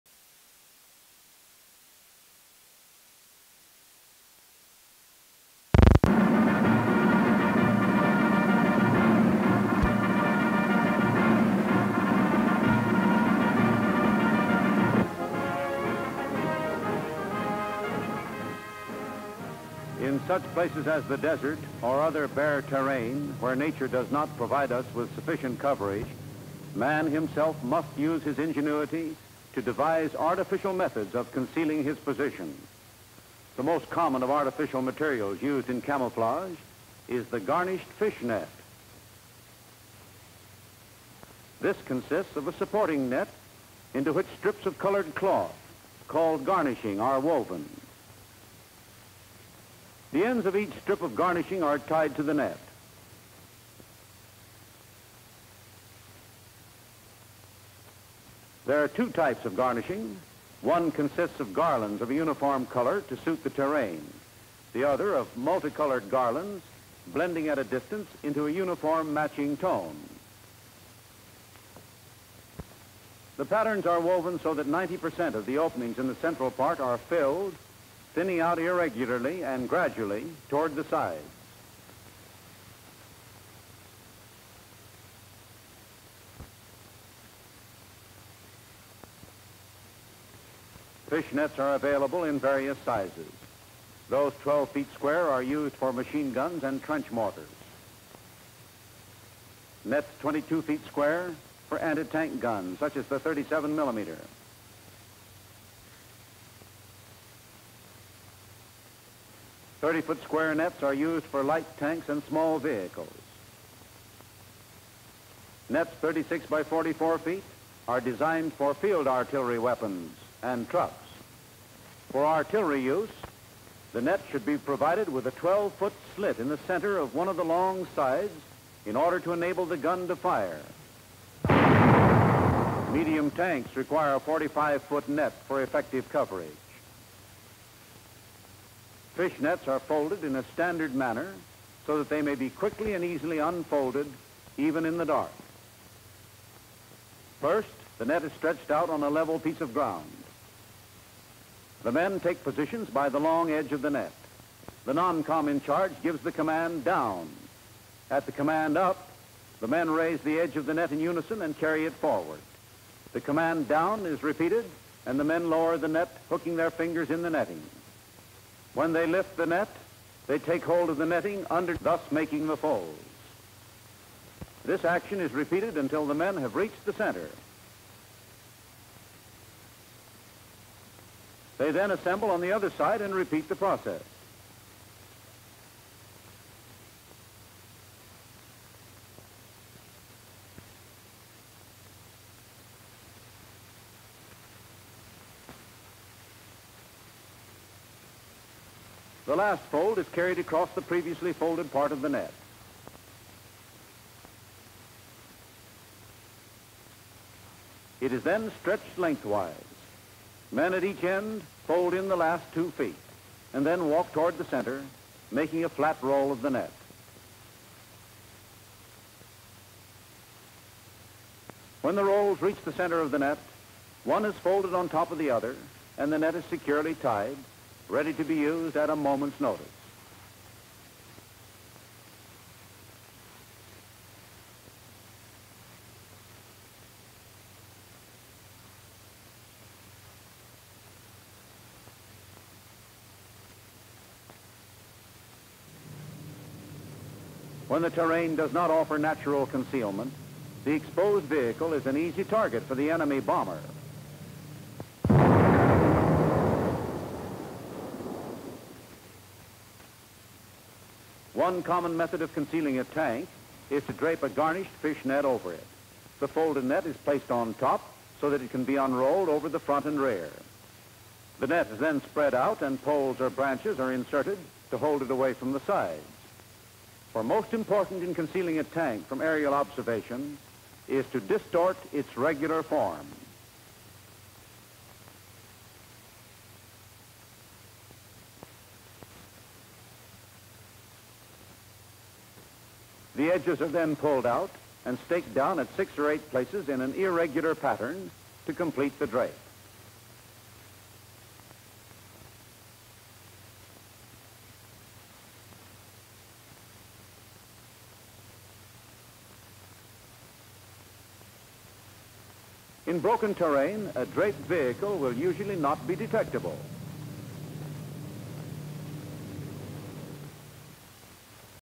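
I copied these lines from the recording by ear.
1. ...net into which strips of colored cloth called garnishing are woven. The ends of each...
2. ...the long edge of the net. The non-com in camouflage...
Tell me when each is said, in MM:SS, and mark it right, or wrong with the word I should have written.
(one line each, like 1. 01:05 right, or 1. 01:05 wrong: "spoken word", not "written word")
1. 00:43 right
2. 02:33 wrong: "charge", not "camouflage".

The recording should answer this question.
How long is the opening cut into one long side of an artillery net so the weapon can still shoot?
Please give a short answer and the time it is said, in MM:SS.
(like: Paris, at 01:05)
12 feet, at 02:05.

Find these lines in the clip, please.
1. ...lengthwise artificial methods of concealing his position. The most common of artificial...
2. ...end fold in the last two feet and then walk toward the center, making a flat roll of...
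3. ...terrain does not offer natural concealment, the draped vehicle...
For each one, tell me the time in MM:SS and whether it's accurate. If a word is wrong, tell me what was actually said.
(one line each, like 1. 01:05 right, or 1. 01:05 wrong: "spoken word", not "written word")
1. 00:29 wrong: "devise", not "lengthwise"
2. 03:31 right
3. 04:07 wrong: "exposed", not "draped".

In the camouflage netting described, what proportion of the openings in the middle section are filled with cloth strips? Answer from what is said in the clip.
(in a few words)
90%.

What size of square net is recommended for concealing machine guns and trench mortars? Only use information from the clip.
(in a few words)
12 feet square.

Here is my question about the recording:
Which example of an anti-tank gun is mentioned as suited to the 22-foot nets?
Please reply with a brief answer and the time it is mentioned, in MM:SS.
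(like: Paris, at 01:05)
37 millimeter, at 01:43.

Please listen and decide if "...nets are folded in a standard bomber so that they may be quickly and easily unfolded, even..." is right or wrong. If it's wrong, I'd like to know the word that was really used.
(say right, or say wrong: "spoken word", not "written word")
wrong: "manner", not "bomber".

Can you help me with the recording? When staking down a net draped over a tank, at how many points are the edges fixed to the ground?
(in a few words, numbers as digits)
6 or 8.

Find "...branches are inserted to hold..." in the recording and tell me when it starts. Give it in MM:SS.
04:33.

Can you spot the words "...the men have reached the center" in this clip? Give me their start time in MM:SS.
02:56.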